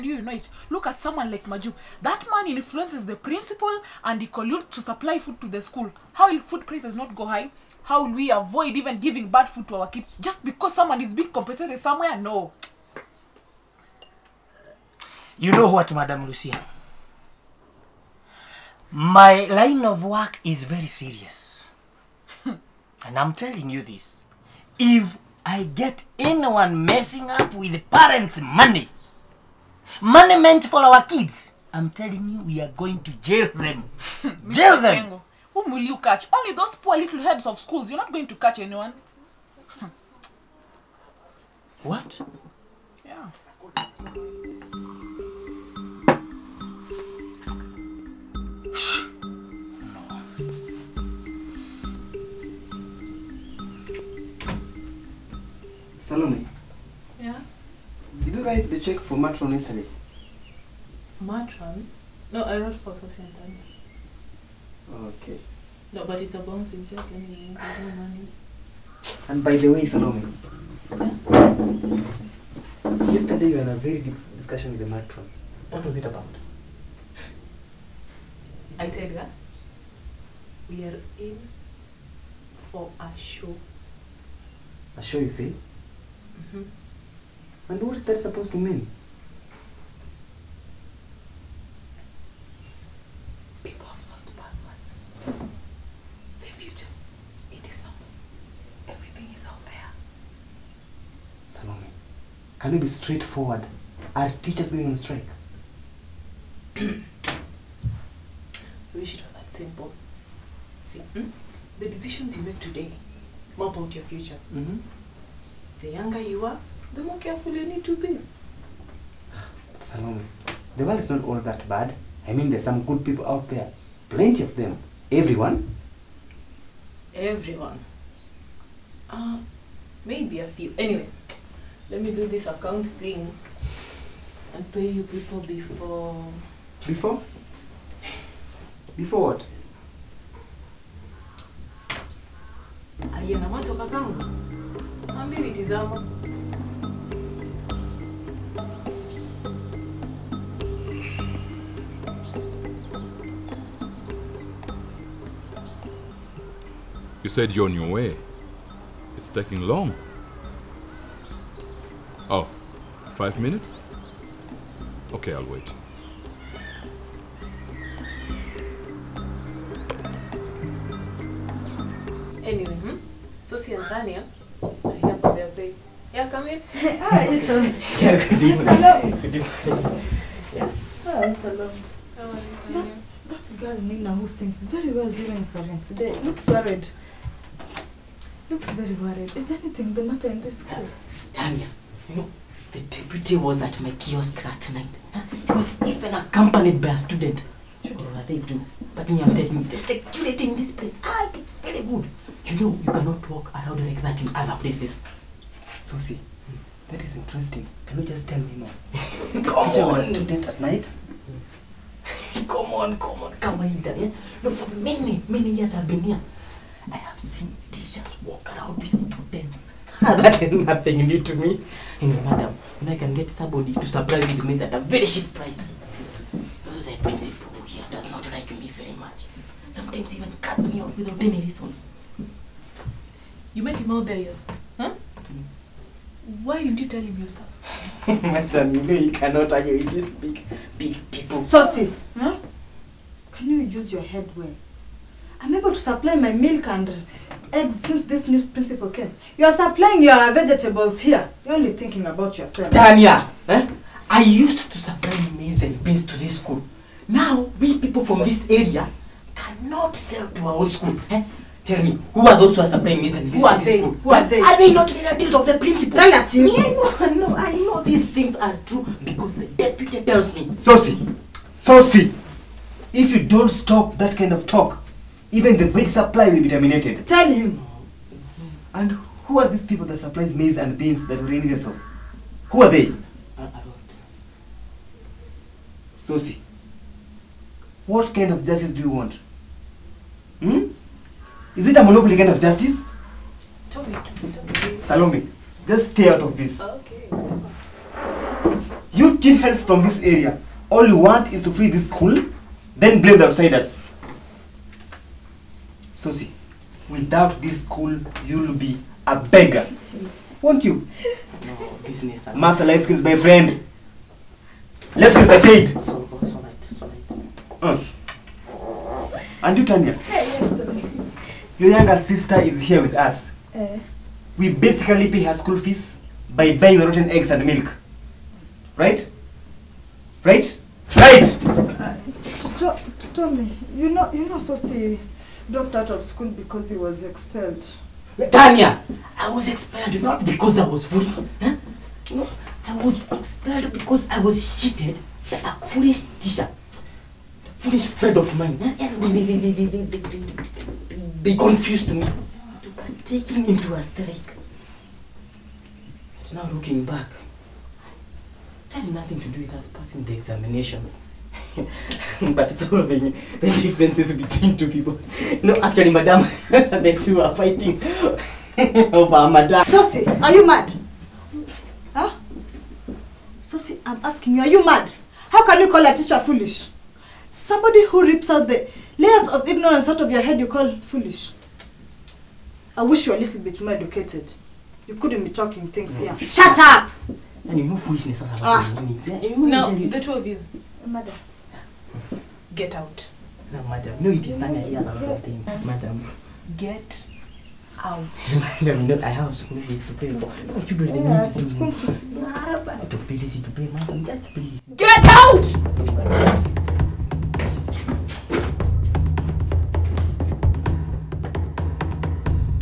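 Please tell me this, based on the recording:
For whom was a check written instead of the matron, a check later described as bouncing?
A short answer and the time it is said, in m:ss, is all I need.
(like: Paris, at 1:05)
Sophie, at 1:02.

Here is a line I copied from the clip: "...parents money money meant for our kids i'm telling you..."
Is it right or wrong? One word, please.
right.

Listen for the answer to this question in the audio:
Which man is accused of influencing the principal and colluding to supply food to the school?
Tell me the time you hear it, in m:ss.
0:01.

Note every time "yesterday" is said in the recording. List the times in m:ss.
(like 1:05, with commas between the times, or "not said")
0:59, 1:13.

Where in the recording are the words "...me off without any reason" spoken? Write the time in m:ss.
3:50.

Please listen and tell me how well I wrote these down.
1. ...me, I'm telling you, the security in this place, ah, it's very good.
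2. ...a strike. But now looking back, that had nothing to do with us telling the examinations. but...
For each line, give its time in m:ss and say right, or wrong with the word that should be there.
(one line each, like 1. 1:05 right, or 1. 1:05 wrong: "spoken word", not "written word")
1. 3:19 right
2. 5:53 wrong: "passing", not "telling".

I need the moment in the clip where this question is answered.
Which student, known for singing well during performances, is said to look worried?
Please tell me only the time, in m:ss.
3:03.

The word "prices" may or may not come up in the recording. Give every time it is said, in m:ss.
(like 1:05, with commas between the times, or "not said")
0:06, 3:45.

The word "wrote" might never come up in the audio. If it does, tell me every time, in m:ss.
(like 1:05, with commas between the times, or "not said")
1:02.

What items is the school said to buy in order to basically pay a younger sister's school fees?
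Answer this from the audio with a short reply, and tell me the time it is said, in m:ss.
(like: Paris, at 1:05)
rotten eggs and milk, at 5:26.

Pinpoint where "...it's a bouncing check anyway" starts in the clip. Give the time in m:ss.
1:06.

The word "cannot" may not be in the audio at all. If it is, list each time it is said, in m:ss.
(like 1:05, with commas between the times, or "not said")
3:22, 3:59, 4:19.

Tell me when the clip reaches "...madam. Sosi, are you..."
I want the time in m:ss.
6:09.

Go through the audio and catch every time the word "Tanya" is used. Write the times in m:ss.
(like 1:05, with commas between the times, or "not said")
2:53, 3:11, 4:12, 5:19, 5:38.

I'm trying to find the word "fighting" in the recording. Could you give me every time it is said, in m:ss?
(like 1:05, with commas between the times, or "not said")
6:07.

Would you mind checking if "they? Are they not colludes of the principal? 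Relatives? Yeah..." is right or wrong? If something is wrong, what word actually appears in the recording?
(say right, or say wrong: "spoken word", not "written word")
wrong: "relatives", not "colludes".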